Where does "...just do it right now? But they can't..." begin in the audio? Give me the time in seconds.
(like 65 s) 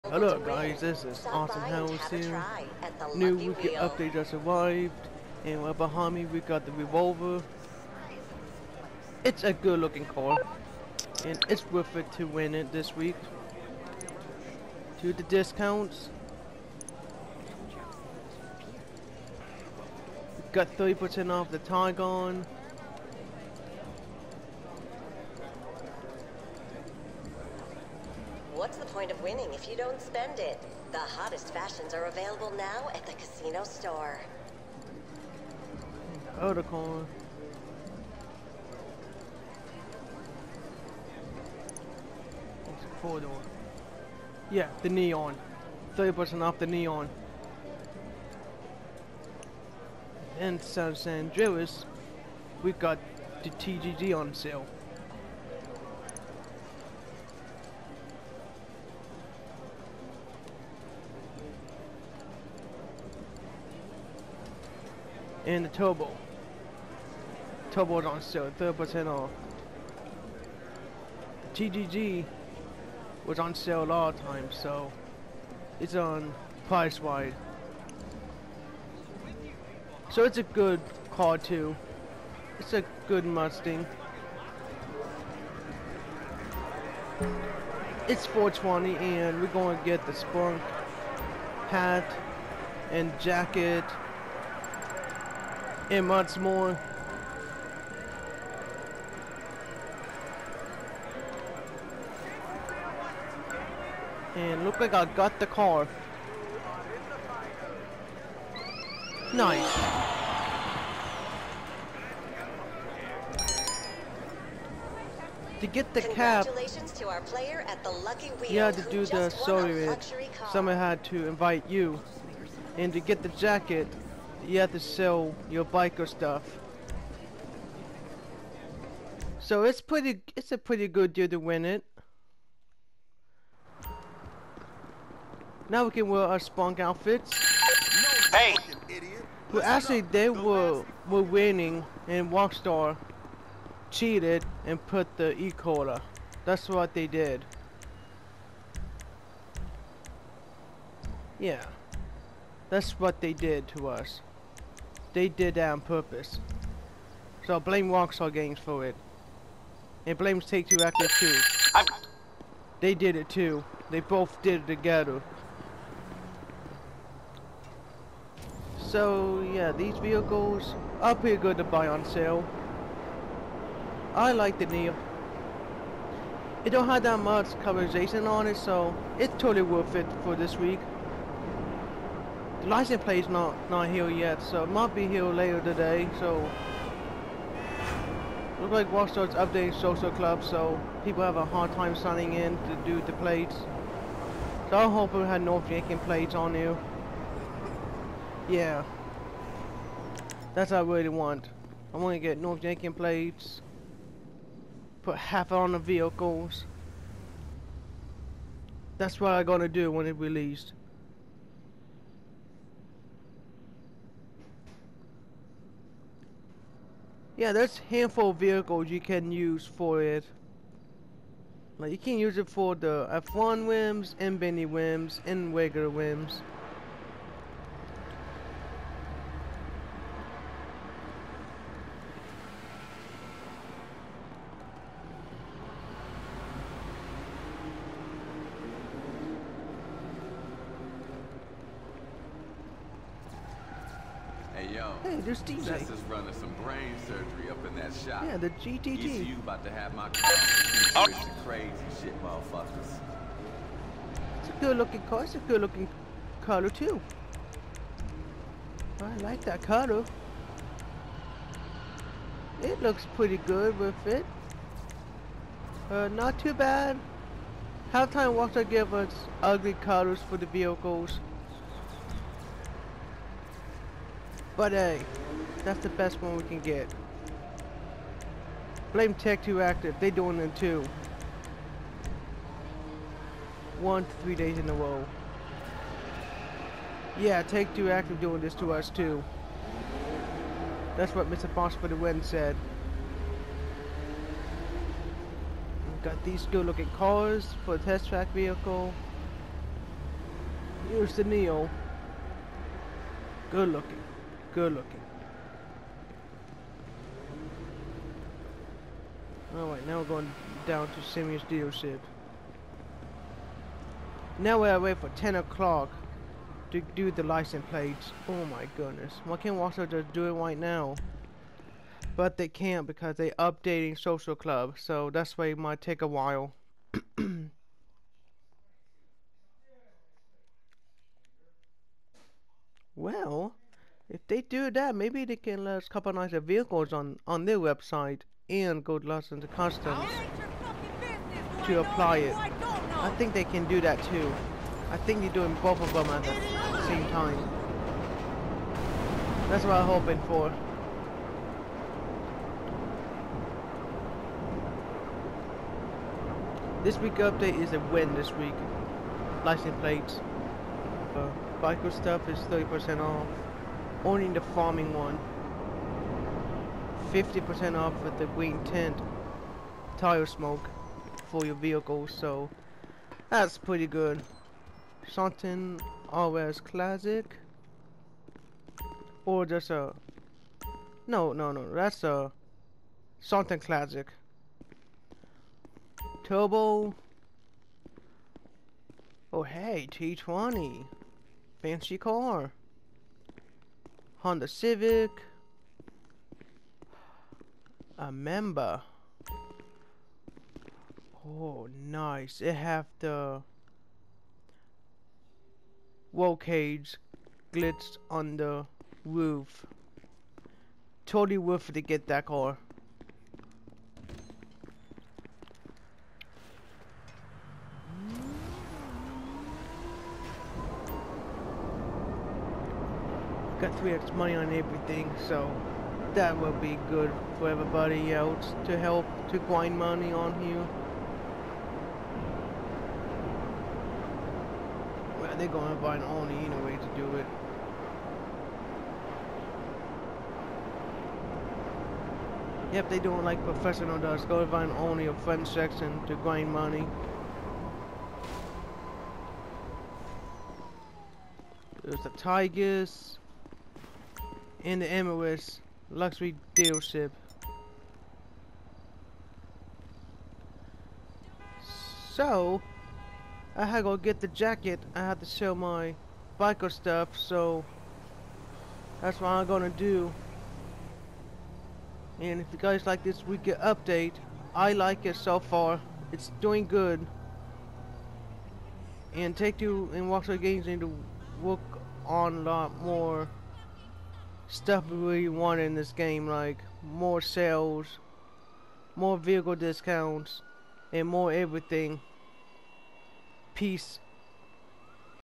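319 s.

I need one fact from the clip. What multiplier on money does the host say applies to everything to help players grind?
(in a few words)
3x.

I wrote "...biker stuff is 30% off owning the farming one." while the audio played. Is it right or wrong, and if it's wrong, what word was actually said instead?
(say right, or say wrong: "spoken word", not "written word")
right.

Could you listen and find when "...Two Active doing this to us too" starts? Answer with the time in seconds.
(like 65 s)
287 s.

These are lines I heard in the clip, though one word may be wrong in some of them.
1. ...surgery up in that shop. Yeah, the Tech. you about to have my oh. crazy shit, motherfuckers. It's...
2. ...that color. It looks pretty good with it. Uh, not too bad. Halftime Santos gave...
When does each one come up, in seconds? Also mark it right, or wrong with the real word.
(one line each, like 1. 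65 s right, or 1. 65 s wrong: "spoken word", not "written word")
1. 247 s wrong: "GTT", not "Tech"
2. 259 s wrong: "Walker", not "Santos".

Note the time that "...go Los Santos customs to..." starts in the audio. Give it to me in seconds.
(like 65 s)
338 s.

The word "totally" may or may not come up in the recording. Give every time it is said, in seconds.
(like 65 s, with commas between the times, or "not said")
179 s, 411 s.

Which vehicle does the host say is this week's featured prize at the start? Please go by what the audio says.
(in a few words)
Revolter.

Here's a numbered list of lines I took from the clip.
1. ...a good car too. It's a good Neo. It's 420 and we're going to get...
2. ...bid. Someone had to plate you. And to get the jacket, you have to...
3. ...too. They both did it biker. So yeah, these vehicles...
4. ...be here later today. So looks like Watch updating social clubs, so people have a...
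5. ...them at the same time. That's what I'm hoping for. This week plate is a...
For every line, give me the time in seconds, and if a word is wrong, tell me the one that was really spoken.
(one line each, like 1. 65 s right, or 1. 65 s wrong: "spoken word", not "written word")
1. 80 s wrong: "Mustang", not "Neo"
2. 119 s wrong: "invite", not "plate"
3. 163 s wrong: "together", not "biker"
4. 184 s right
5. 345 s wrong: "update", not "plate".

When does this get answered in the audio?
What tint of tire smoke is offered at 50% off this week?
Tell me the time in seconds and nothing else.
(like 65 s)
368 s.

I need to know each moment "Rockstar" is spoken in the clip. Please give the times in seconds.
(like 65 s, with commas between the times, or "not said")
142 s, 157 s.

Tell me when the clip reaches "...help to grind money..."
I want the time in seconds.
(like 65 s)
428 s.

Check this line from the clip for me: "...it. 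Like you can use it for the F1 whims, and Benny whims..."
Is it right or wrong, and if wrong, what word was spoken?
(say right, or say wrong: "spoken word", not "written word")
right.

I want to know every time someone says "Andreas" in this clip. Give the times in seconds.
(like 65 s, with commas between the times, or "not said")
51 s.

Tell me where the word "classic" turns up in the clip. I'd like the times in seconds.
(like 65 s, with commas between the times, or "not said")
376 s, 383 s.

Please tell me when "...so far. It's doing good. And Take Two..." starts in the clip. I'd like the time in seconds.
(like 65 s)
475 s.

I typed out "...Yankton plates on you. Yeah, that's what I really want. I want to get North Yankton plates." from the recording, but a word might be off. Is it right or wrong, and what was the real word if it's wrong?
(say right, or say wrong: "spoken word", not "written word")
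right.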